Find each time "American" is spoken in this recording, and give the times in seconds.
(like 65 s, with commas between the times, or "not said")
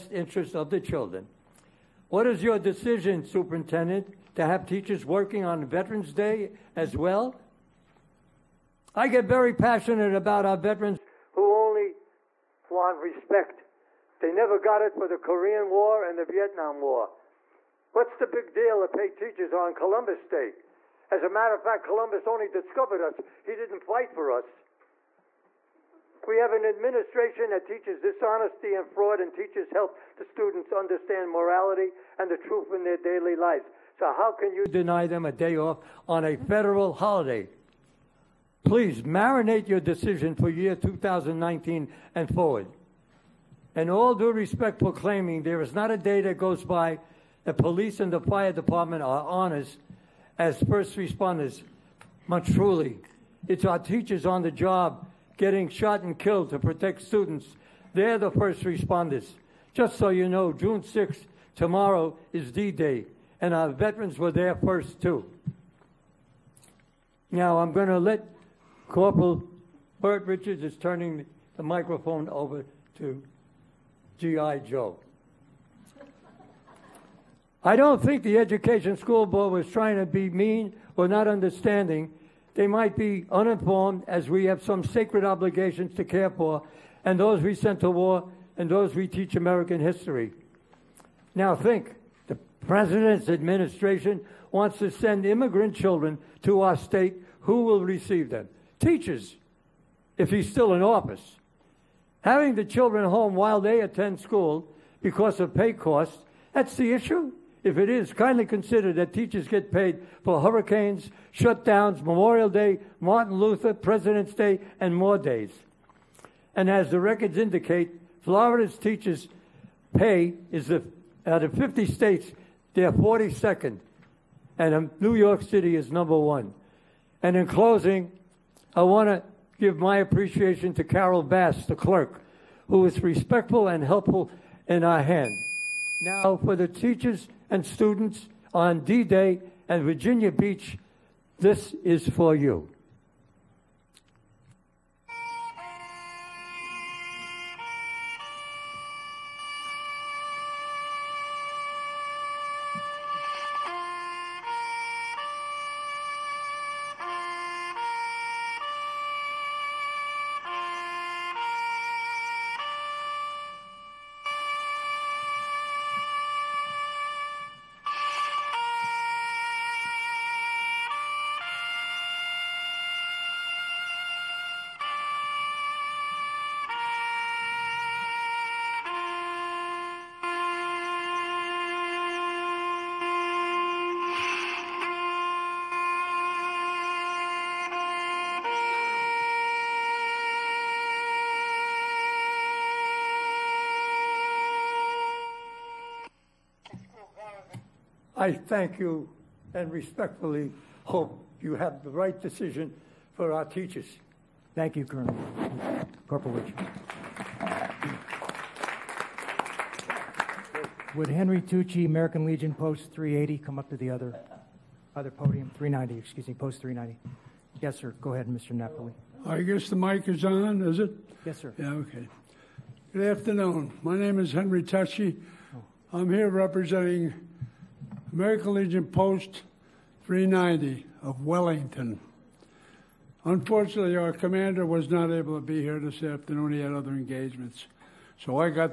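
89 s, 211 s, 228 s.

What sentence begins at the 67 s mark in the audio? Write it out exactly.
Now, I'm going to let Corporal Bert Richards is turning the microphone over to G.I.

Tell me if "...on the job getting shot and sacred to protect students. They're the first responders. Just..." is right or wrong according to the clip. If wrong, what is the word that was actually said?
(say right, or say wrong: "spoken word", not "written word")
wrong: "killed", not "sacred".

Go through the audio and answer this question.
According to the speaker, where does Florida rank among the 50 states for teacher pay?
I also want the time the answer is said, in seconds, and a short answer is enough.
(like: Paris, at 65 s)
42nd, at 122 s.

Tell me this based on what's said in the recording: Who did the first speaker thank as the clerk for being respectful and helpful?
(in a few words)
Carol Bass.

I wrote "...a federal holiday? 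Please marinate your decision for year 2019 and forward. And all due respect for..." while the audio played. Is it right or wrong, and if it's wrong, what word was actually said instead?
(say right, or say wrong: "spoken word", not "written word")
right.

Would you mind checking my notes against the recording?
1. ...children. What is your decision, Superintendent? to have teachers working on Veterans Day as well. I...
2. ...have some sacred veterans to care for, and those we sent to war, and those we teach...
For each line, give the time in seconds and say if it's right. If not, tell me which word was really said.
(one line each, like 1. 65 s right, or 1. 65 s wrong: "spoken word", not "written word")
1. 0 s right
2. 84 s wrong: "obligations", not "veterans".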